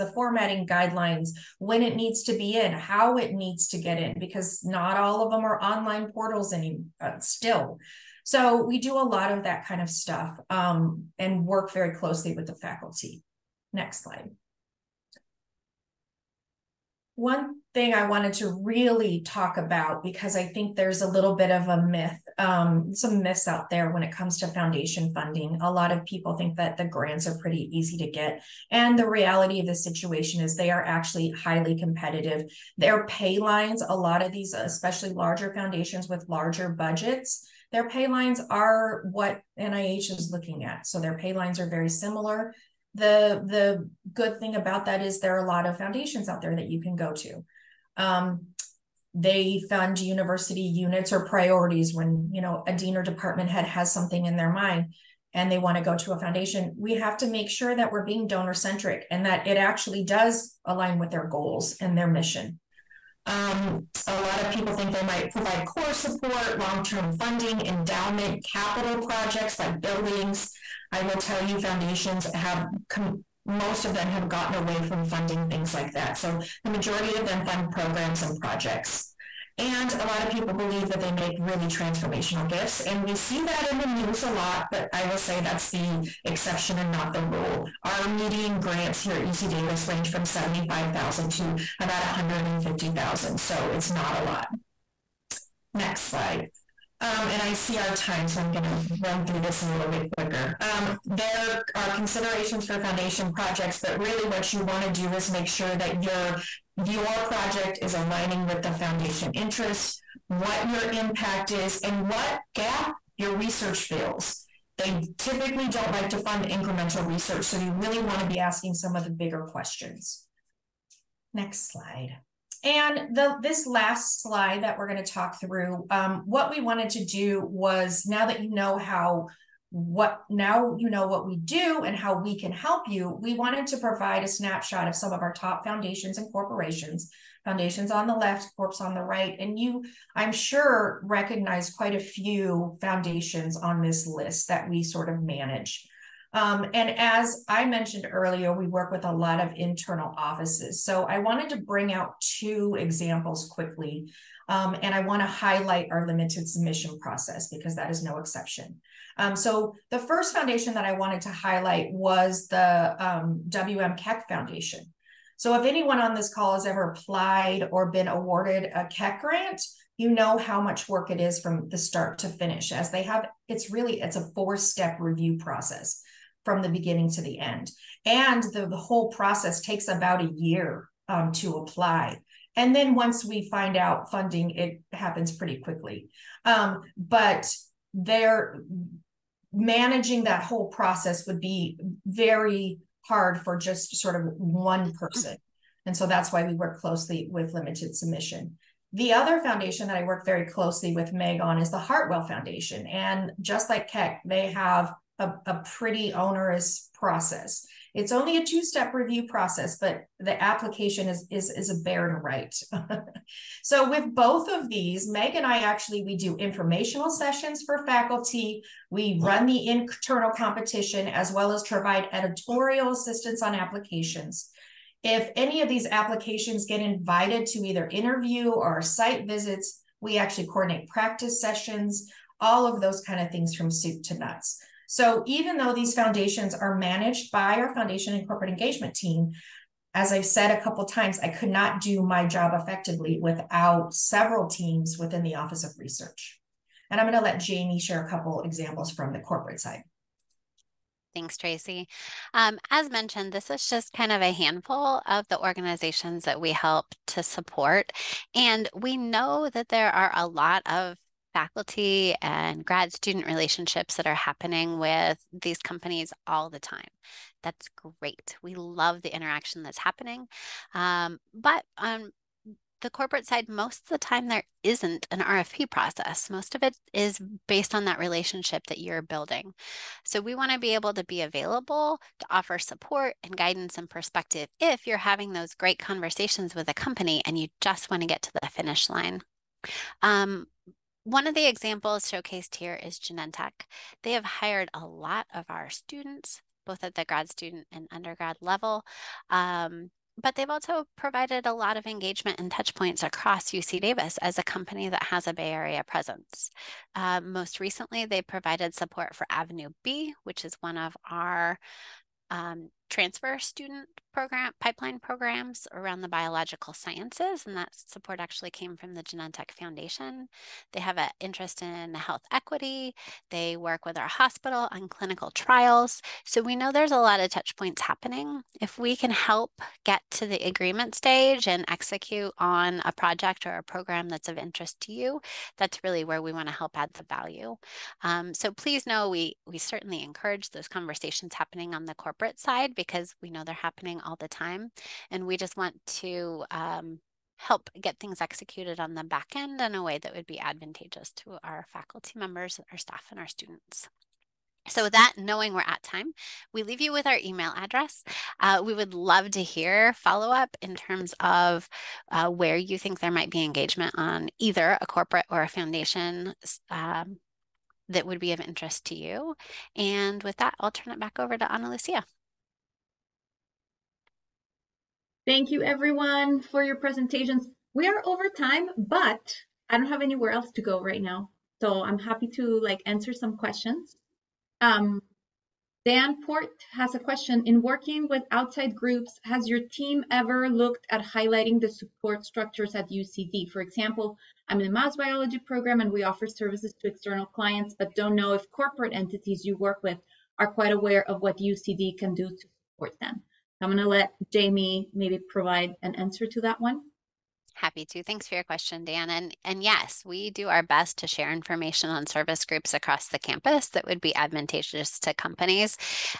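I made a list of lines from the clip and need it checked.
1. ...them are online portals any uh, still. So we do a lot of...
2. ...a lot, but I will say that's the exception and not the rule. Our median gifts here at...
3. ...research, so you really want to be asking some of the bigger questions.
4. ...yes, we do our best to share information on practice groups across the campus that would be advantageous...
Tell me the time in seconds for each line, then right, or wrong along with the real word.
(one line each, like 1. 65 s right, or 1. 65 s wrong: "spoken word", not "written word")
1. 5 s right
2. 84 s wrong: "grants", not "gifts"
3. 117 s right
4. 409 s wrong: "service", not "practice".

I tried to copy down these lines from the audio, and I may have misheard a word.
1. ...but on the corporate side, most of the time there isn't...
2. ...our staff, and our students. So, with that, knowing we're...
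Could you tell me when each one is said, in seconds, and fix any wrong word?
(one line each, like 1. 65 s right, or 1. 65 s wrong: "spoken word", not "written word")
1. 271 s right
2. 352 s right.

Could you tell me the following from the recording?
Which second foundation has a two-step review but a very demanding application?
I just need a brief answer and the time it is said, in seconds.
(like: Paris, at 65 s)
Hartwell Foundation, at 201 s.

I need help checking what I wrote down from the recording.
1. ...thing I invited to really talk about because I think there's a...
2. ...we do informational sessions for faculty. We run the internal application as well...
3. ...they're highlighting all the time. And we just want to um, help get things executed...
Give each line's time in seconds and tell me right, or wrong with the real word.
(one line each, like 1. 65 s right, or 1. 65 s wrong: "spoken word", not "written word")
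1. 17 s wrong: "wanted", not "invited"
2. 216 s wrong: "competition", not "application"
3. 343 s wrong: "happening", not "highlighting".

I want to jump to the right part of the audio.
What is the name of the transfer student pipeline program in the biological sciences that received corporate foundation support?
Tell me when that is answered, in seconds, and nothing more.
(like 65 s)
309 s.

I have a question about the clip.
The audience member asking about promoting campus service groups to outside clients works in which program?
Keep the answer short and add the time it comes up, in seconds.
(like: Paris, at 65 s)
mouse biology program, at 394 s.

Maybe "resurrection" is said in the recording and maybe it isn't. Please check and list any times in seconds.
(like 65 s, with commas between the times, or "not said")
not said.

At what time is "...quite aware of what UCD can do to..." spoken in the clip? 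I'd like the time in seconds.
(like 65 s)
400 s.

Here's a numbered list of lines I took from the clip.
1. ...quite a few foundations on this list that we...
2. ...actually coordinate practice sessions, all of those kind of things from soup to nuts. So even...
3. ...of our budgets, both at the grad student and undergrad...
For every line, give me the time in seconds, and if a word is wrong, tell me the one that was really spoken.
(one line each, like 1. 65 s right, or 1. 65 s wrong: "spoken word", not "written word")
1. 141 s right
2. 230 s right
3. 295 s wrong: "students", not "budgets".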